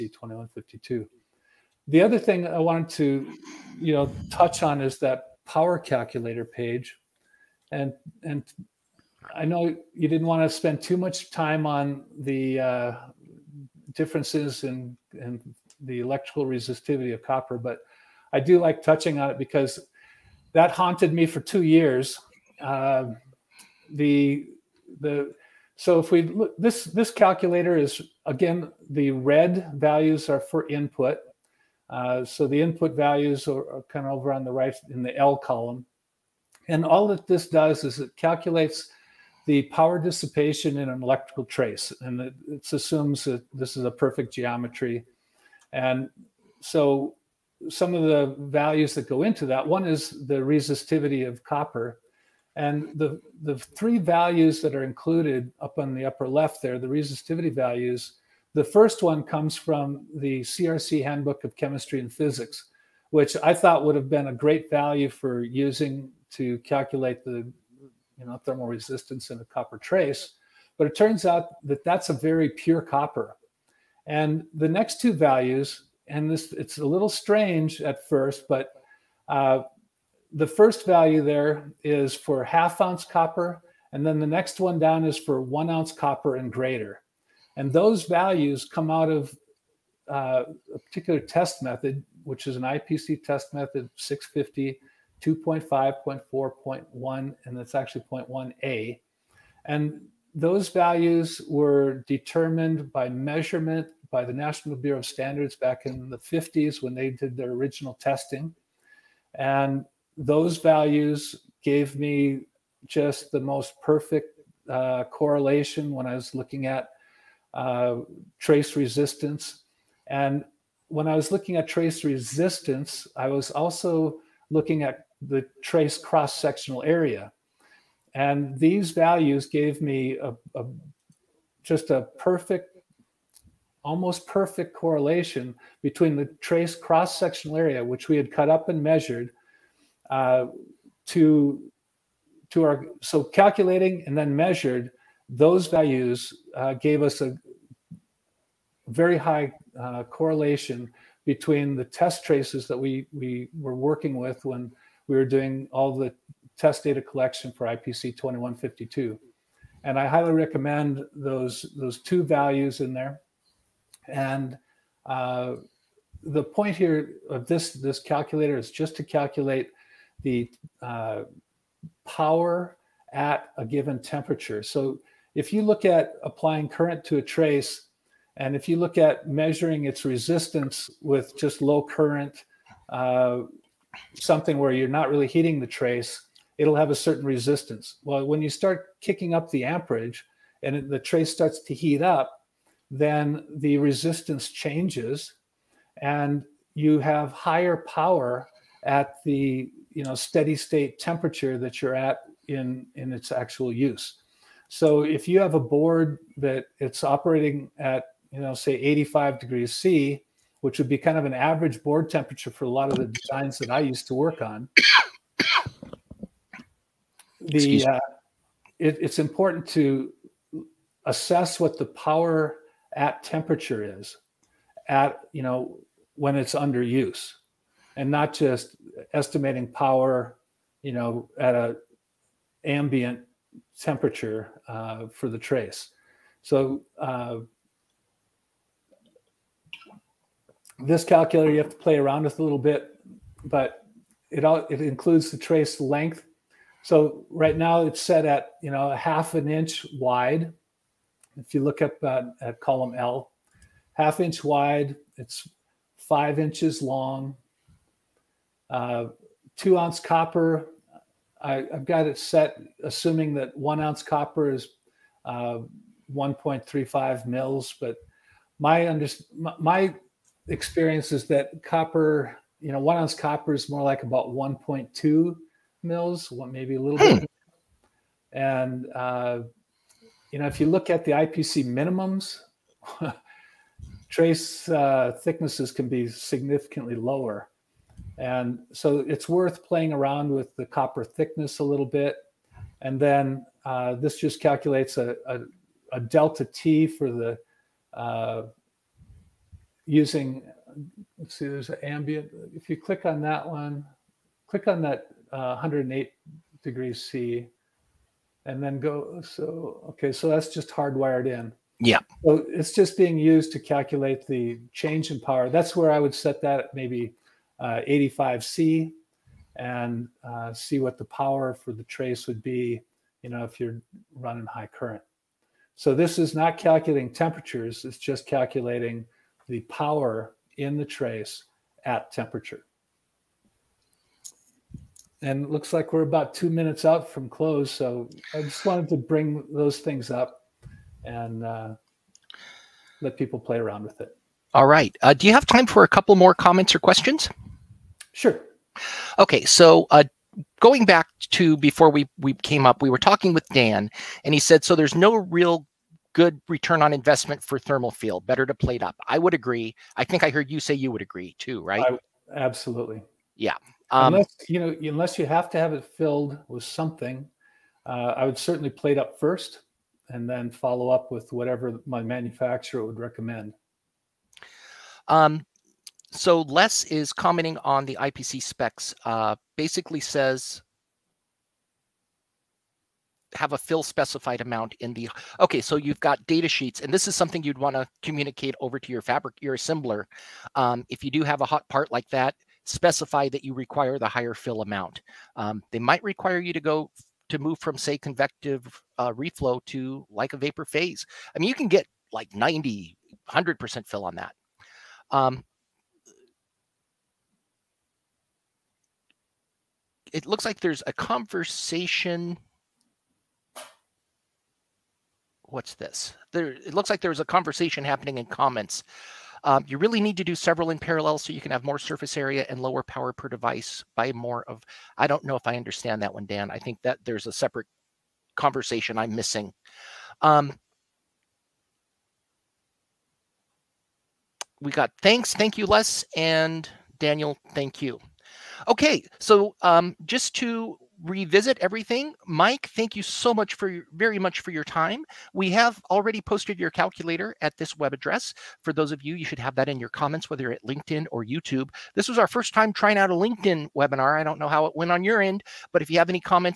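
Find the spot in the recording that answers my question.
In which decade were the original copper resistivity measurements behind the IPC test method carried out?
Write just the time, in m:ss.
1:46.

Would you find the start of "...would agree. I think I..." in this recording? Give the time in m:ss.
5:59.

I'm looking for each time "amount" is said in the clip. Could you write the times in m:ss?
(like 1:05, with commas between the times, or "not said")
6:24, 6:34.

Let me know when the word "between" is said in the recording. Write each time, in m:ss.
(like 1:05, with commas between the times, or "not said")
2:15, 2:31.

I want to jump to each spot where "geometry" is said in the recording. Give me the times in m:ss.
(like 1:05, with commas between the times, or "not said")
0:44.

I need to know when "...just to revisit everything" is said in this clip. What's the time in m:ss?
7:20.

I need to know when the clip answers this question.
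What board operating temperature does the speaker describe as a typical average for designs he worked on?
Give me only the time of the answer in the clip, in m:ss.
3:28.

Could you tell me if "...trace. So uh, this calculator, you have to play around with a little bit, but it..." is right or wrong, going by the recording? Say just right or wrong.
right.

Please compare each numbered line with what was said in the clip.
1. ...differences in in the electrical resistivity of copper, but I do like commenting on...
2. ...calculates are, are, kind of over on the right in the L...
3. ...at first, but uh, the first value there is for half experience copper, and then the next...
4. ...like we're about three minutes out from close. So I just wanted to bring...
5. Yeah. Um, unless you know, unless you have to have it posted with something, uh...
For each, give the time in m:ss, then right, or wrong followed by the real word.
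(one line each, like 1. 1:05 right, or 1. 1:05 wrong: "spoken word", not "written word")
1. 0:13 wrong: "touching", not "commenting"
2. 0:32 wrong: "values", not "calculates"
3. 1:17 wrong: "ounce", not "experience"
4. 5:35 wrong: "two", not "three"
5. 6:03 wrong: "filled", not "posted".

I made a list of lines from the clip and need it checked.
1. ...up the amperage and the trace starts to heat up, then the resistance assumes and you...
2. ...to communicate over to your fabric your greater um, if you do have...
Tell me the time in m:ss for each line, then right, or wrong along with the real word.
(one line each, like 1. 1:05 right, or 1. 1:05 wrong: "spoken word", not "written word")
1. 3:09 wrong: "changes", not "assumes"
2. 6:27 wrong: "assembler", not "greater".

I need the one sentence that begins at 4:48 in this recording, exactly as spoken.
And so it's worth playing around with the copper thickness a little bit.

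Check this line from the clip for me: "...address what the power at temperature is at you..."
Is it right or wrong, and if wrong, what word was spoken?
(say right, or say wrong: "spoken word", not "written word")
wrong: "assess", not "address".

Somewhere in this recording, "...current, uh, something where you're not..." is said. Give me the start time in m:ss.
3:01.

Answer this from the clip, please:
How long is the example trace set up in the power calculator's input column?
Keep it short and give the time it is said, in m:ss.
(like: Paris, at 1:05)
5 inches, at 4:15.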